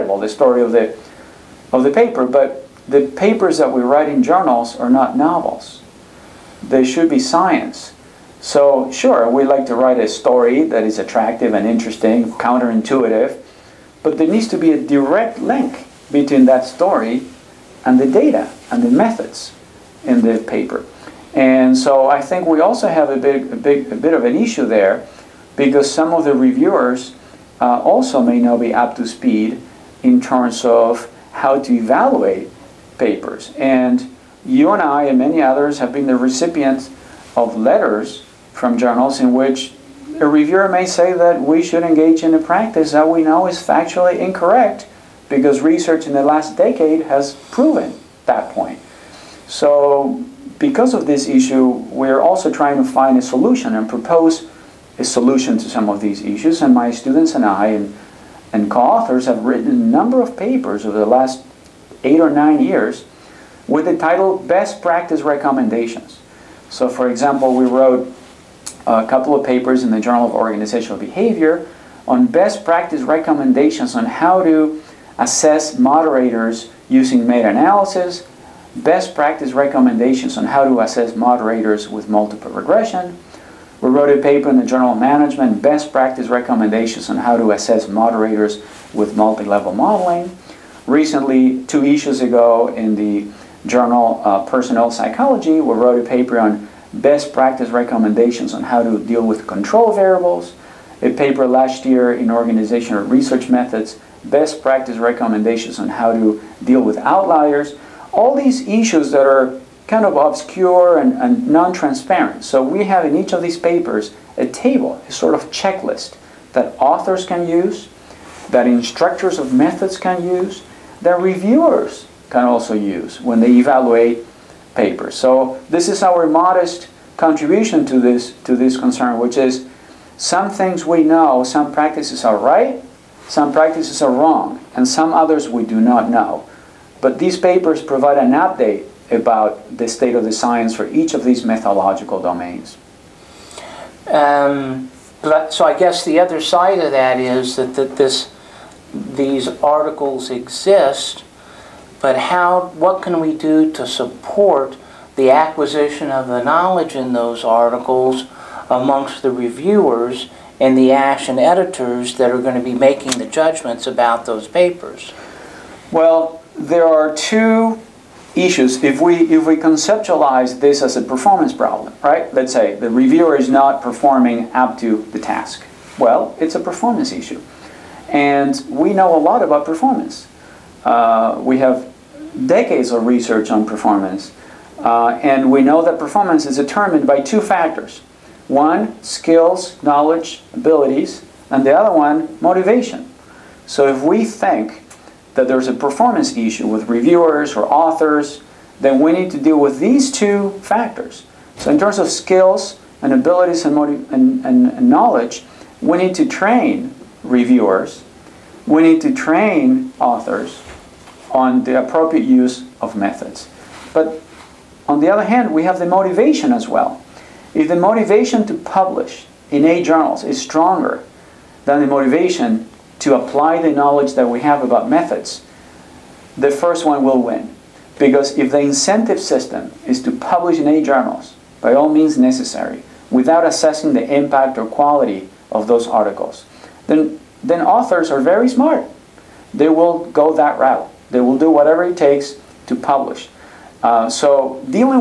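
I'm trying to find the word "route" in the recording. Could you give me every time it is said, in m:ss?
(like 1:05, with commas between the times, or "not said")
4:00.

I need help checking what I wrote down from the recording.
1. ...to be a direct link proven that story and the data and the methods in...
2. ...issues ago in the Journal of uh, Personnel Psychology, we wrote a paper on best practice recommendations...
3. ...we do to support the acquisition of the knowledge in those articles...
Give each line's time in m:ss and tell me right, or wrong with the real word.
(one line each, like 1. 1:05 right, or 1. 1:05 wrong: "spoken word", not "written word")
1. 0:14 wrong: "between", not "proven"
2. 1:31 right
3. 2:33 right.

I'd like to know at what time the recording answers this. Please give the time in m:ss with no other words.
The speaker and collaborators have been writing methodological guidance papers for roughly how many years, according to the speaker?
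1:02.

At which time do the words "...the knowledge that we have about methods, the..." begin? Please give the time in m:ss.
3:43.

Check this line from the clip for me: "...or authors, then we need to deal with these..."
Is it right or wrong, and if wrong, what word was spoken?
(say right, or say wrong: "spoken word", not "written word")
right.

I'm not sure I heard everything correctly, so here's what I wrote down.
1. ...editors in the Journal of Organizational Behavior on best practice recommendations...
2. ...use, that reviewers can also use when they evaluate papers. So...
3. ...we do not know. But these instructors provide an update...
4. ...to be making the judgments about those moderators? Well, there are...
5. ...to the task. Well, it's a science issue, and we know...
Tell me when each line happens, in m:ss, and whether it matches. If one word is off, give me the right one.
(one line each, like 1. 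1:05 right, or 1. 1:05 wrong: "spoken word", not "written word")
1. 1:09 wrong: "papers", not "editors"
2. 2:00 right
3. 2:15 wrong: "papers", not "instructors"
4. 2:42 wrong: "papers", not "moderators"
5. 2:54 wrong: "performance", not "science".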